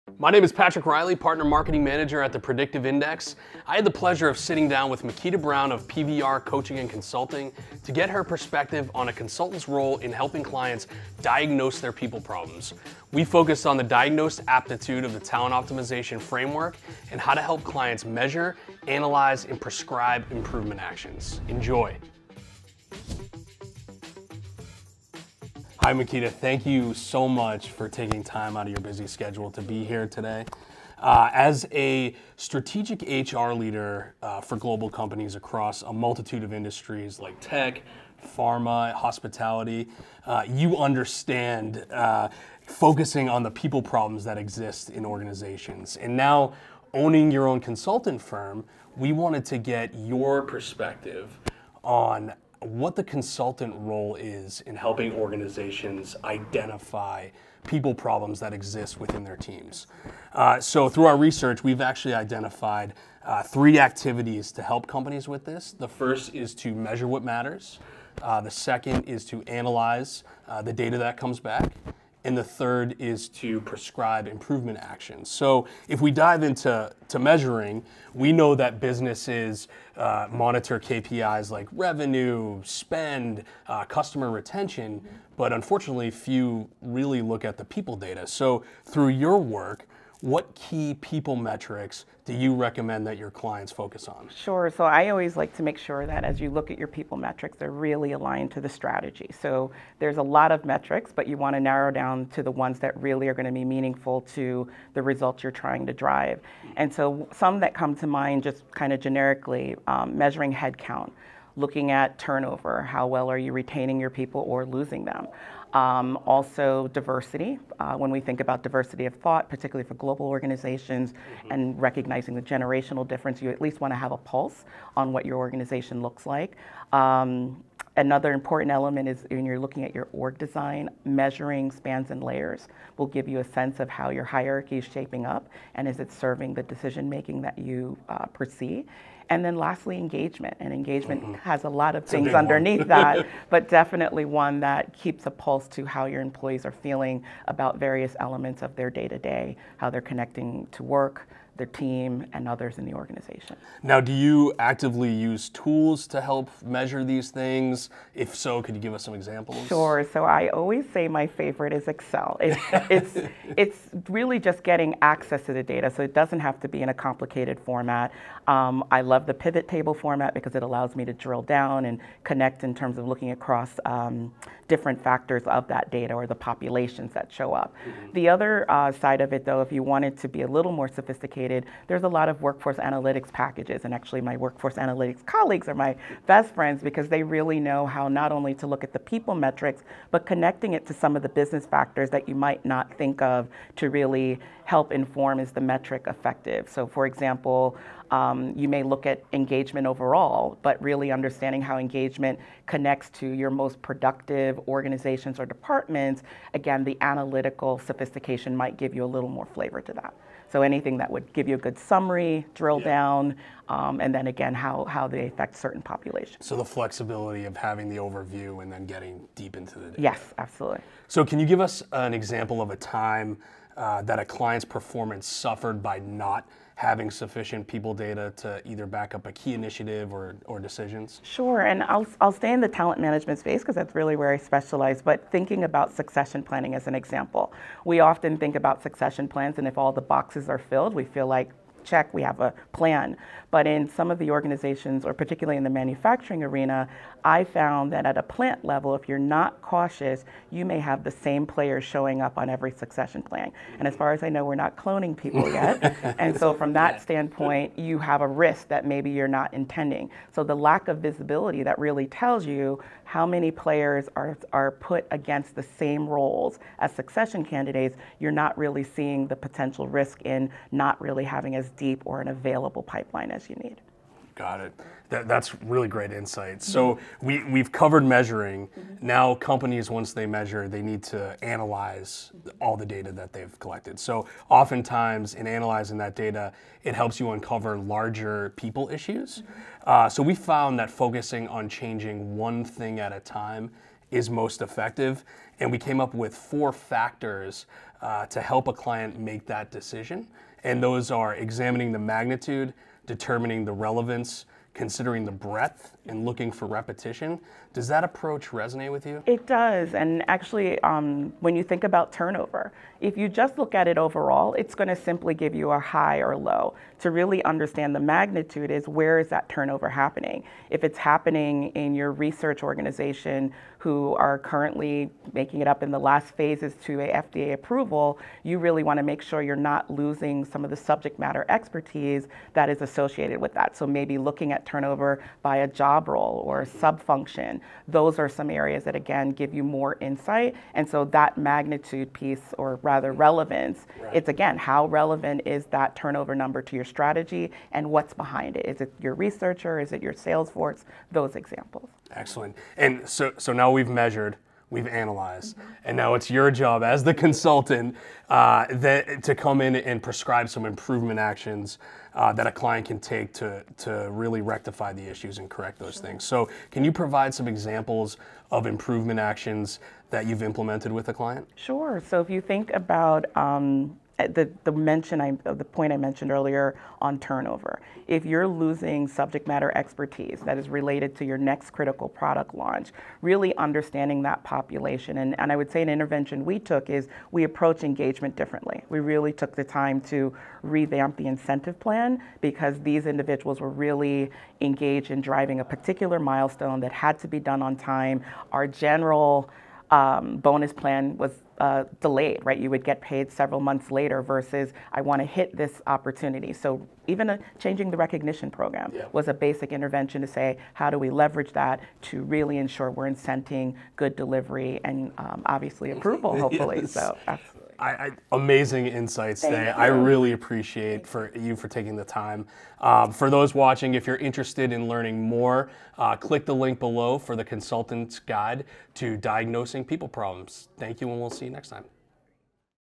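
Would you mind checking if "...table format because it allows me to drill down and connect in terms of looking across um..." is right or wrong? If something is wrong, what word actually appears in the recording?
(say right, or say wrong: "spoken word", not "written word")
right.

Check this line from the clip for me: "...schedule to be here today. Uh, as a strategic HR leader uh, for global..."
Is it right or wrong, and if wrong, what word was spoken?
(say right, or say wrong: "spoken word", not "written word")
right.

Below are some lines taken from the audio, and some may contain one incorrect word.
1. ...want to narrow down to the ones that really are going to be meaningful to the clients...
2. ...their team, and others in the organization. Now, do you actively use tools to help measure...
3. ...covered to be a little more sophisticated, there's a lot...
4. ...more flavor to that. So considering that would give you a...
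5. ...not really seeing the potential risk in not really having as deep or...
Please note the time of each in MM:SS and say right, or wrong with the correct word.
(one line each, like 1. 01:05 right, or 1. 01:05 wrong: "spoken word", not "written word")
1. 01:41 wrong: "results", not "clients"
2. 02:31 right
3. 02:59 wrong: "wanted", not "covered"
4. 03:29 wrong: "anything", not "considering"
5. 04:28 right.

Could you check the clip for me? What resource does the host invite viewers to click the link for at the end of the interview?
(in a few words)
Consultant's Guide to Diagnosing People Problems.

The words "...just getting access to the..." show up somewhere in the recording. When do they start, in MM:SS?
02:44.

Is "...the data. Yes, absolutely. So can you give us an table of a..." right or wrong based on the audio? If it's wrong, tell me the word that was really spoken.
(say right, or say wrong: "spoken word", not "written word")
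wrong: "example", not "table".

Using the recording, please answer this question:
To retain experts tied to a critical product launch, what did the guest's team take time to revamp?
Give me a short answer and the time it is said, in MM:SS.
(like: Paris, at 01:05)
The incentive plan, at 06:31.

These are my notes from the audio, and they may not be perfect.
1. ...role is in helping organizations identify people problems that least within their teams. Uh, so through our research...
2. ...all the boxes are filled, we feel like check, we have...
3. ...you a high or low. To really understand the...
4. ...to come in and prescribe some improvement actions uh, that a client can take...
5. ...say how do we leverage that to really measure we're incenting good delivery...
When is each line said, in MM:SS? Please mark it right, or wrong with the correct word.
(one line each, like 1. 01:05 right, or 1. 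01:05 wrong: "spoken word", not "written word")
1. 00:53 wrong: "exist", not "least"
2. 03:59 right
3. 05:15 right
4. 05:59 right
5. 06:50 wrong: "ensure", not "measure".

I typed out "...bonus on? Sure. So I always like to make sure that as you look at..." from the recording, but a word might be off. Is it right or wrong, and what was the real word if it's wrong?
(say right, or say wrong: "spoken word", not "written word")
wrong: "focus", not "bonus".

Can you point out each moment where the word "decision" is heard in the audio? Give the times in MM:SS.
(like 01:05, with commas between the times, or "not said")
02:16, 03:50, 04:59.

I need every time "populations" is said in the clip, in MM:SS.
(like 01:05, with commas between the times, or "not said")
02:56, 03:35, 06:24.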